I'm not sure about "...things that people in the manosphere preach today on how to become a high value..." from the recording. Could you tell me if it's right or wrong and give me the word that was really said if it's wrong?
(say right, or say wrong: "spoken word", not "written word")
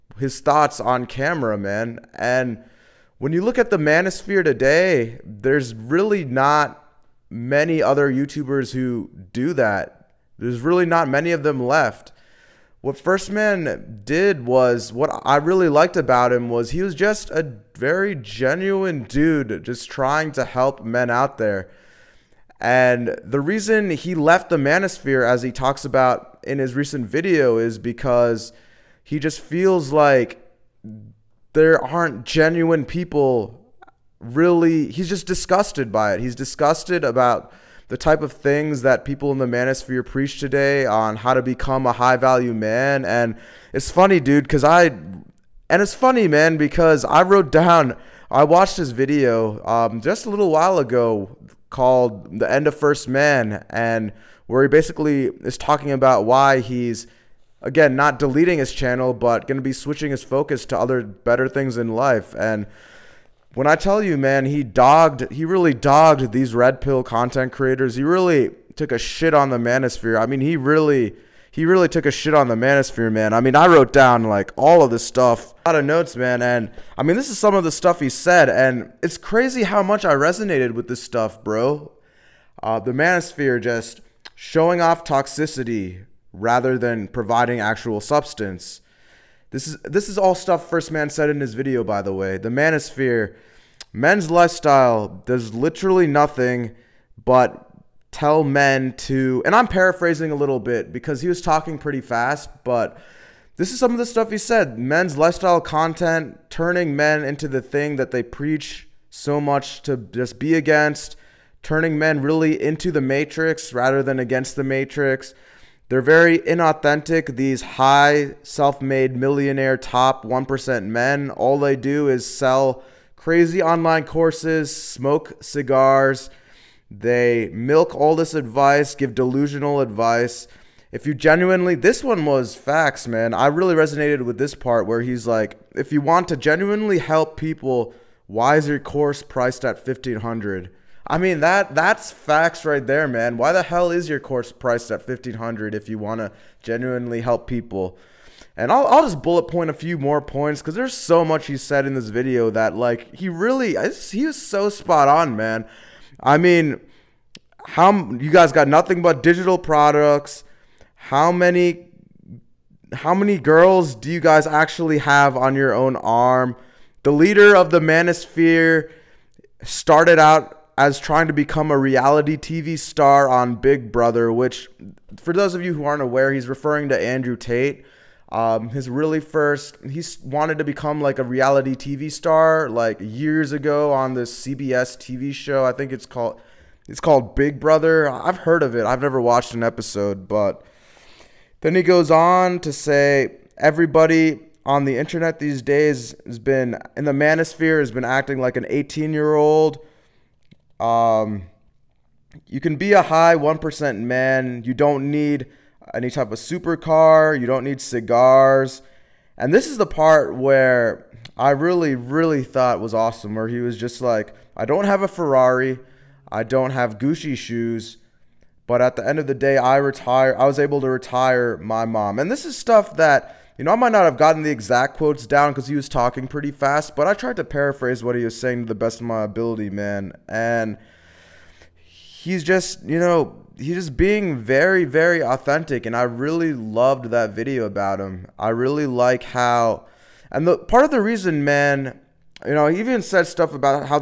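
right.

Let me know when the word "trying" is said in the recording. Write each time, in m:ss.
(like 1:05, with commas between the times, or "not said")
0:19, 2:50.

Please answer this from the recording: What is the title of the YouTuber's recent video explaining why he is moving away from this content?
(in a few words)
The End of First Man.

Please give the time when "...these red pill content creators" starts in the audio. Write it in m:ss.
1:06.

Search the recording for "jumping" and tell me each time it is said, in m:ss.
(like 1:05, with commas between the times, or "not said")
not said.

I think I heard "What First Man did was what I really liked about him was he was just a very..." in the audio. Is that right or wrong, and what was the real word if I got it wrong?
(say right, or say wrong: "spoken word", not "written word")
right.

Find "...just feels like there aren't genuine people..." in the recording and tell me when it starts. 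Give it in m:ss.
0:29.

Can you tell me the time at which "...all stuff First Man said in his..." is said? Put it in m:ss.
1:30.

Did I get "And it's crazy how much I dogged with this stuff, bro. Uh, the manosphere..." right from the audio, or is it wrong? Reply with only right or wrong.
wrong.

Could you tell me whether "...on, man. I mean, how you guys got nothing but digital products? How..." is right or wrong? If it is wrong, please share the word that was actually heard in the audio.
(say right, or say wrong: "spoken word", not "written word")
right.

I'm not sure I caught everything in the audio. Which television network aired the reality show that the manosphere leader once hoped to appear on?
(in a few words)
CBS.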